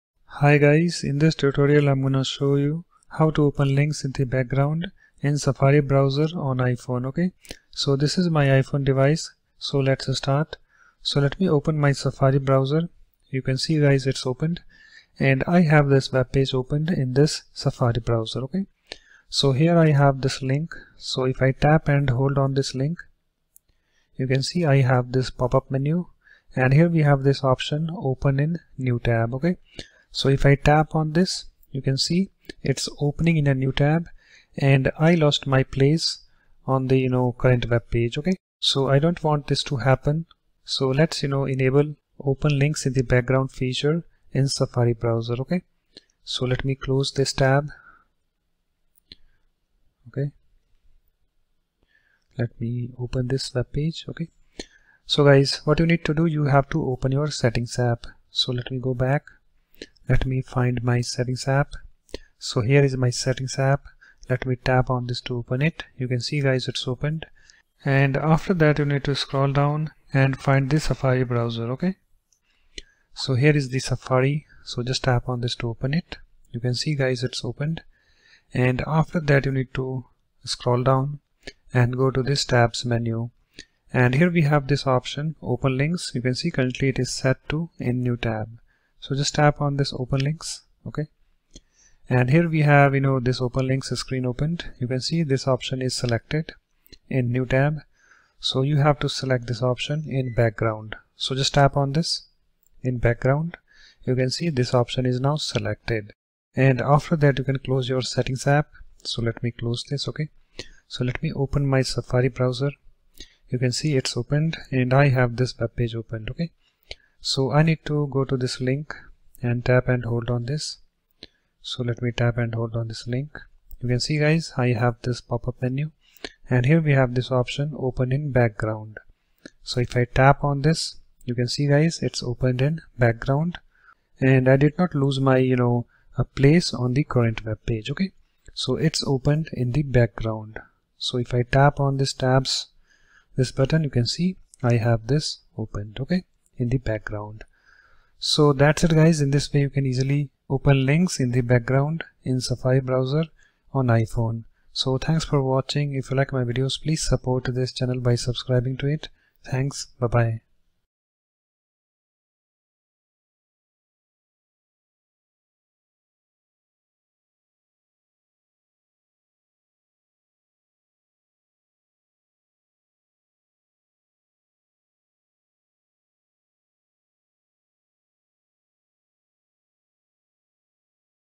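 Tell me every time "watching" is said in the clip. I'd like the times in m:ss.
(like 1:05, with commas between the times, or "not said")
2:35.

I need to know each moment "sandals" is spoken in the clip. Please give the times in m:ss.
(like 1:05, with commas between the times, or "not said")
not said.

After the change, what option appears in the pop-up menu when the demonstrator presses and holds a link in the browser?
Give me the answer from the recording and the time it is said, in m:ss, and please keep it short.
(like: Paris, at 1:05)
Open in background, at 2:07.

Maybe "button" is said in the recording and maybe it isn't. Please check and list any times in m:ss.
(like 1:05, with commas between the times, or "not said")
2:23.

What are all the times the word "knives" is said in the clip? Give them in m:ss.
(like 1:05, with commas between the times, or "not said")
not said.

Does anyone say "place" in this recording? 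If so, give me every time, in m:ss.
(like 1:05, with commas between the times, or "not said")
0:35, 2:16.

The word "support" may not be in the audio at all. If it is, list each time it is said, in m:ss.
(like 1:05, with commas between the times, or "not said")
2:37.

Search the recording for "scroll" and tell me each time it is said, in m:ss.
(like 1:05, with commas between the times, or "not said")
1:09, 1:20.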